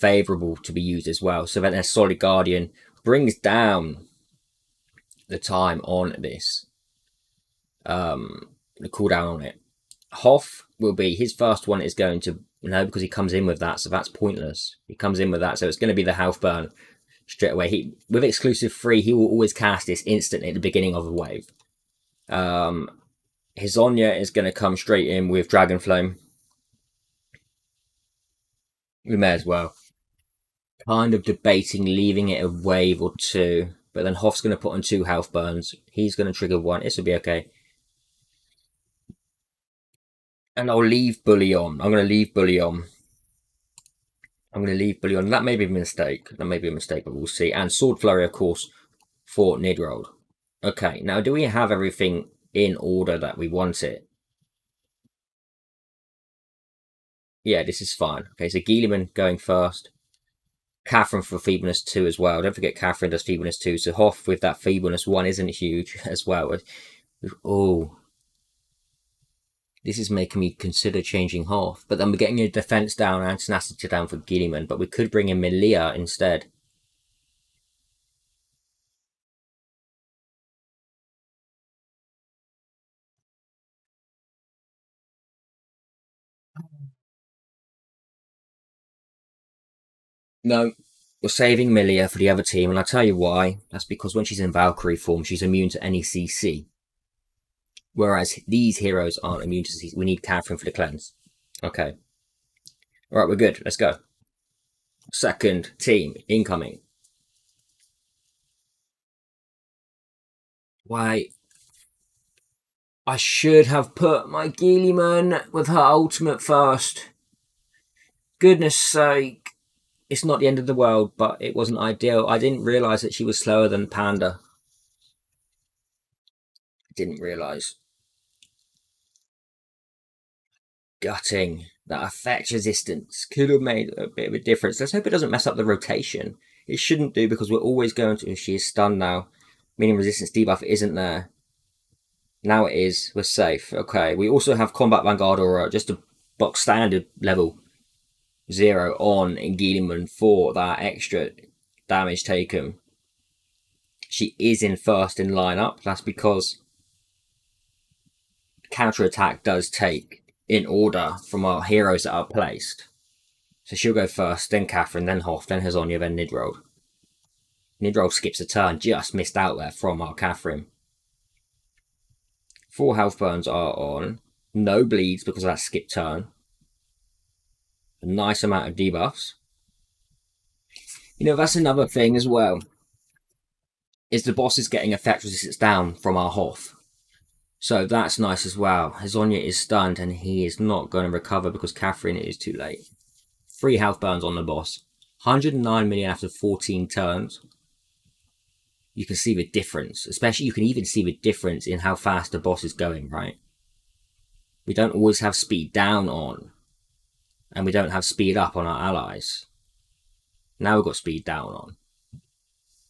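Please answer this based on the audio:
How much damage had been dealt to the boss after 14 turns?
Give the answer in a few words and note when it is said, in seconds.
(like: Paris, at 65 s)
109 million, at 195 s.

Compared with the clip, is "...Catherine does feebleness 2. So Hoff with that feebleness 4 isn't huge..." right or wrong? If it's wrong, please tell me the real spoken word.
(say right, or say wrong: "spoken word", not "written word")
wrong: "1", not "4".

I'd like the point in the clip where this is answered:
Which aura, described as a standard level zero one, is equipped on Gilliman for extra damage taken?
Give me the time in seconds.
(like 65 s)
144 s.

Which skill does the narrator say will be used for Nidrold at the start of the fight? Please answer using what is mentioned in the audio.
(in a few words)
Sword flurry.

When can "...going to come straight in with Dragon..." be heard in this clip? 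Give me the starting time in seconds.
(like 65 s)
24 s.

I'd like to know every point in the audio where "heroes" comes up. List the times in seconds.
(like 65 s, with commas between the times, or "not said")
98 s, 161 s.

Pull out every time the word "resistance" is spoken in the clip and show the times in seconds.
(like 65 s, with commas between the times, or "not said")
132 s, 139 s, 185 s.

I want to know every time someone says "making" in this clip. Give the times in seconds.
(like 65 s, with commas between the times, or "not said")
70 s.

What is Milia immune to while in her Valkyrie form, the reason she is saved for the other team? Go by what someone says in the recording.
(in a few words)
CC.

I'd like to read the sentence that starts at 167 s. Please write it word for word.
Nidrold skips a turn, just missed out there from our Catherine.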